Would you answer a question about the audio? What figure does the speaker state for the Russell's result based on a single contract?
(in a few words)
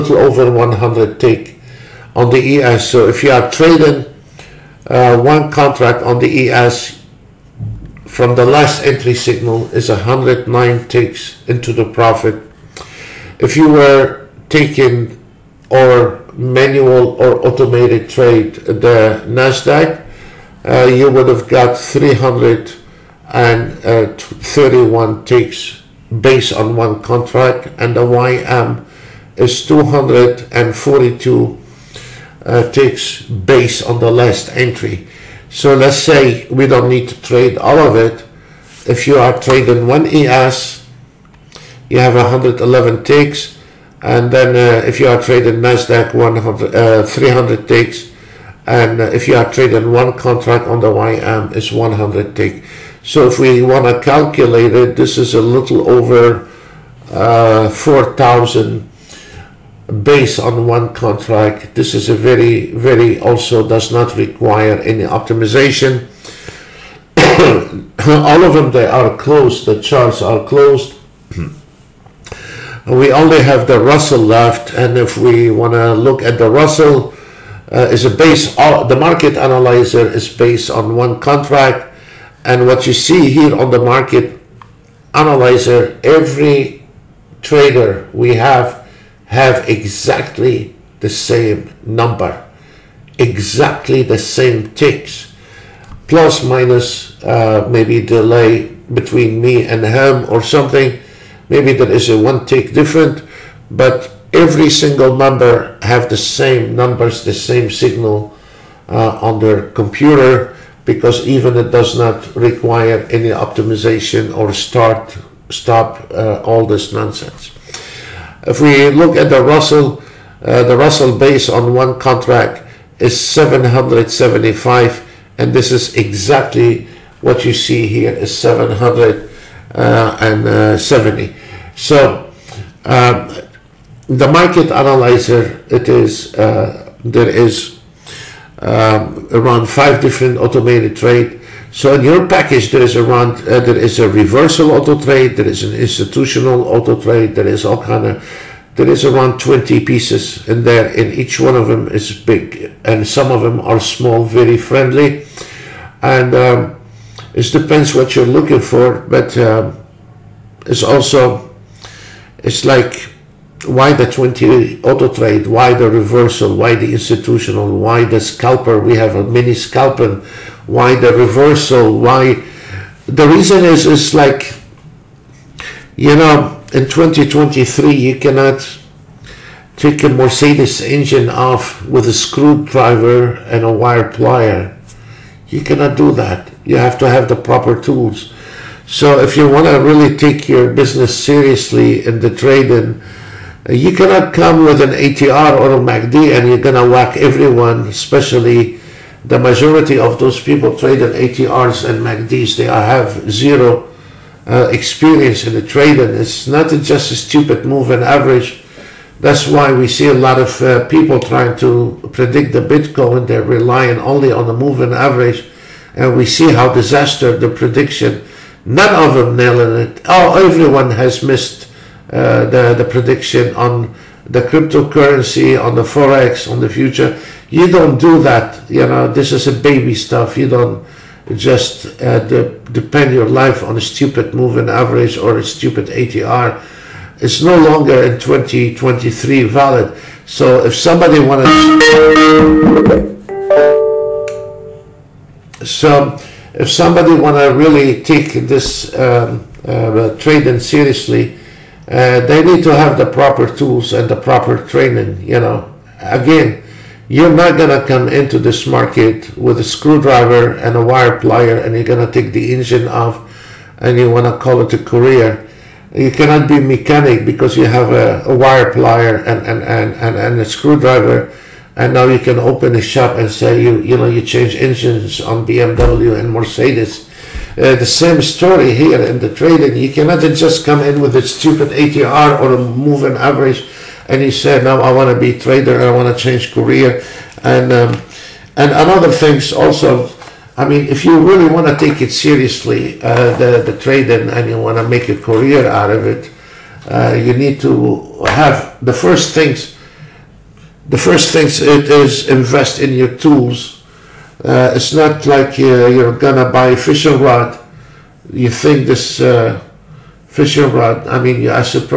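775.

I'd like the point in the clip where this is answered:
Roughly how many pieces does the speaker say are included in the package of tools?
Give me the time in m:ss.
2:29.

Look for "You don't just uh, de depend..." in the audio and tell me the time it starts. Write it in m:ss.
3:50.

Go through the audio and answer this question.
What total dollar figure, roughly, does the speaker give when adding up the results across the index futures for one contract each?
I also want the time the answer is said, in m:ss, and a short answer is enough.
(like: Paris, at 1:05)
a little over 4,000, at 0:55.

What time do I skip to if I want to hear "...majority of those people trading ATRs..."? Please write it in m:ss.
3:19.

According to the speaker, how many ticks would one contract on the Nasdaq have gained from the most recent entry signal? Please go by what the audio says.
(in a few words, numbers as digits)
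331.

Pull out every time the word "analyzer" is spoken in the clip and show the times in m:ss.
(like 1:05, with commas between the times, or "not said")
1:19, 1:25, 2:14.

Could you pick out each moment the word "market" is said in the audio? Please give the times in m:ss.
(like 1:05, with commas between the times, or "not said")
1:18, 1:23, 2:14, 4:18.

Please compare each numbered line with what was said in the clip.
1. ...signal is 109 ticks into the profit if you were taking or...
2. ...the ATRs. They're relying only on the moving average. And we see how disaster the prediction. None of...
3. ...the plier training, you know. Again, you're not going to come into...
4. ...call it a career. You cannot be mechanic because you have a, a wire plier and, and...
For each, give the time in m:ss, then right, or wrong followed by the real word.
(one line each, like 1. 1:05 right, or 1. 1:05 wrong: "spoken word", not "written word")
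1. 0:09 right
2. 3:32 wrong: "Bitcoin", not "ATRs"
3. 4:14 wrong: "proper", not "plier"
4. 4:24 right.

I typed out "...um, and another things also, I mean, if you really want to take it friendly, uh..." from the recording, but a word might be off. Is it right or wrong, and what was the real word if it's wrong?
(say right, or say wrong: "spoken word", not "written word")
wrong: "seriously", not "friendly".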